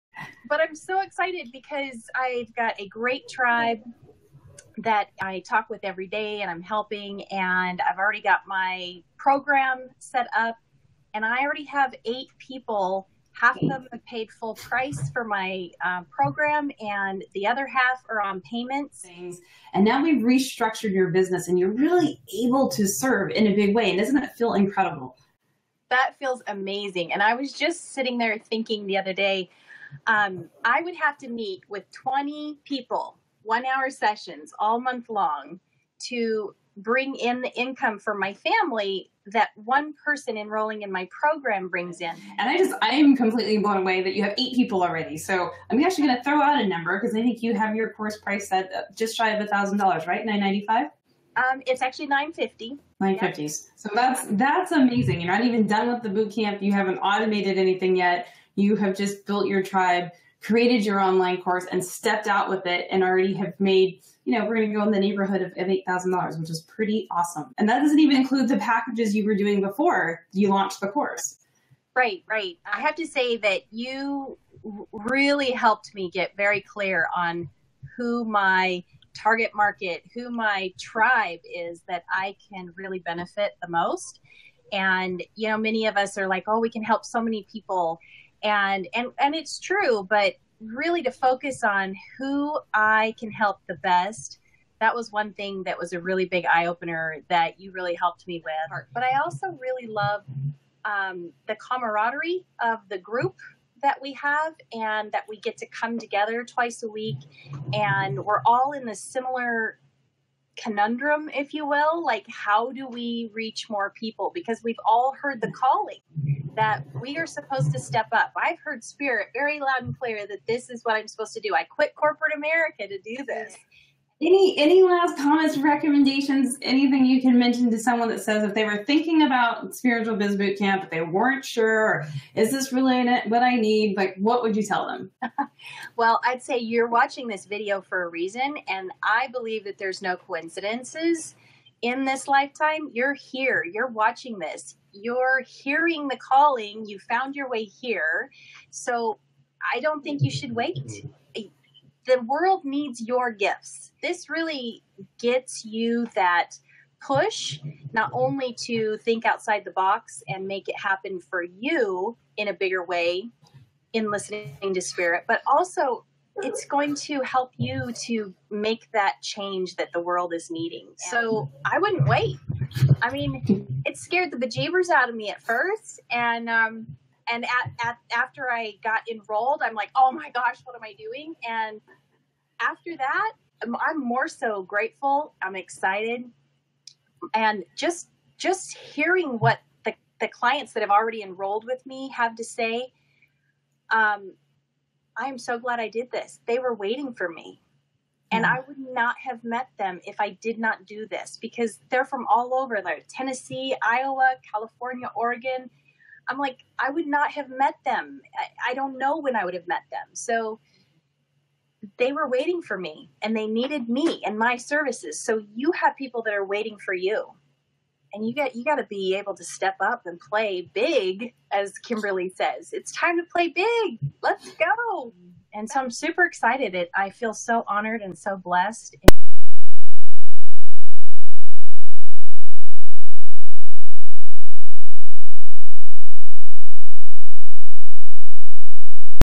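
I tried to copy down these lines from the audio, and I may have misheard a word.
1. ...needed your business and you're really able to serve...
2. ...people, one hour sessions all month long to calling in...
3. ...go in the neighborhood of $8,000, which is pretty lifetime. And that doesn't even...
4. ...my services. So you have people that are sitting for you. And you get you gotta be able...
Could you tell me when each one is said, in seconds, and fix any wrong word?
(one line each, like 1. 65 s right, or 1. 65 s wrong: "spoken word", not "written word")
1. 20 s wrong: "restructured", not "needed"
2. 32 s wrong: "bring", not "calling"
3. 64 s wrong: "awesome", not "lifetime"
4. 214 s wrong: "waiting", not "sitting".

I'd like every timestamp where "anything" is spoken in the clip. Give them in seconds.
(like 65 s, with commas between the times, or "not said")
57 s, 126 s.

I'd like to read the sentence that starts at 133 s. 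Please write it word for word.
Like, what would you tell them?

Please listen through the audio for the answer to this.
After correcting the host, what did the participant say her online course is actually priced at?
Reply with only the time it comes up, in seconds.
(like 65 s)
52 s.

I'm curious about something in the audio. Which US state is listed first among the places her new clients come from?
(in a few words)
Tennessee.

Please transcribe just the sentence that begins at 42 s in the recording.
And I just, I am completely blown away that you have eight people already.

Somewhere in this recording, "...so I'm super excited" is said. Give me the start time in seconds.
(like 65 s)
225 s.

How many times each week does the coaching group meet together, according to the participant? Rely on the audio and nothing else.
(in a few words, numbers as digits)
Twice.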